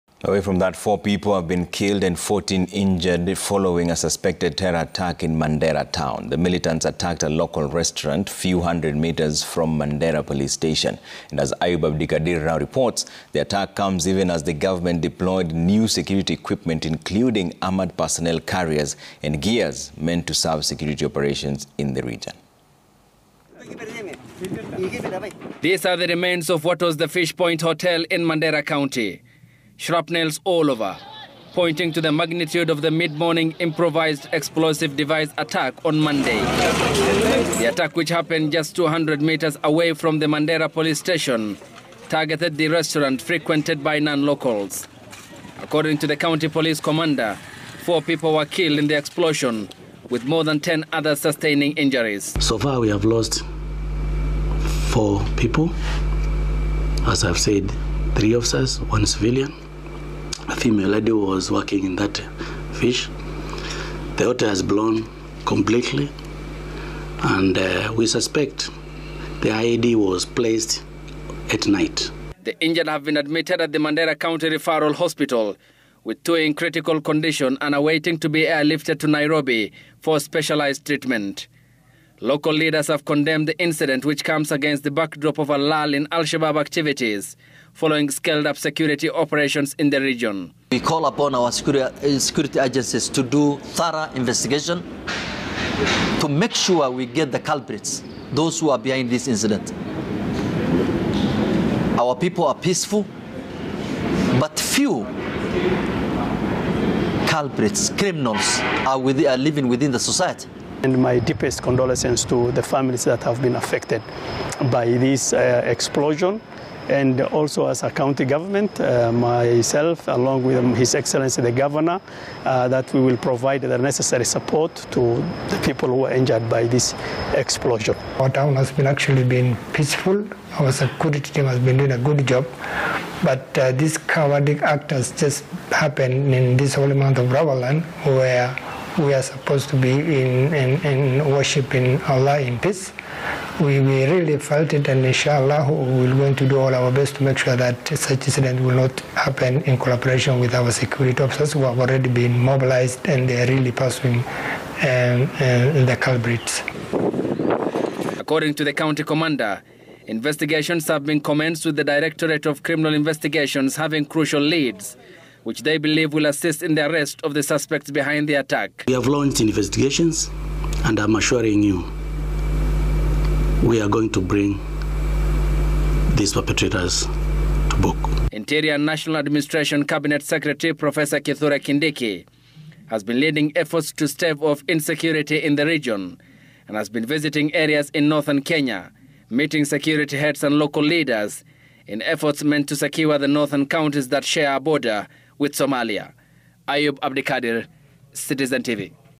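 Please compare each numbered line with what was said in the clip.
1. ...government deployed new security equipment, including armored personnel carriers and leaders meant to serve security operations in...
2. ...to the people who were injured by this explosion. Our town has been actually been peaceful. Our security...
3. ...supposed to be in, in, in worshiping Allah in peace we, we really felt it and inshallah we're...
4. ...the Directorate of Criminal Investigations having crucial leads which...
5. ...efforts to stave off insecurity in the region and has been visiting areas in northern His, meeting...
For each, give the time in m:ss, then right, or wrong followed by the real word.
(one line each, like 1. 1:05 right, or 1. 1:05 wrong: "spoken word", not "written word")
1. 0:14 wrong: "gears", not "leaders"
2. 2:04 right
3. 2:19 right
4. 2:41 right
5. 3:03 wrong: "Kenya", not "His".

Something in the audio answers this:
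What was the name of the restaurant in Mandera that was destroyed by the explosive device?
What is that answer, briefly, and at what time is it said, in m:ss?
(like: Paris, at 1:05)
Fish Point Hotel, at 0:27.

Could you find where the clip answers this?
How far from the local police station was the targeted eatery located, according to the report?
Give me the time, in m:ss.
0:38.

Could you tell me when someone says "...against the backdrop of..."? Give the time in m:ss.
1:24.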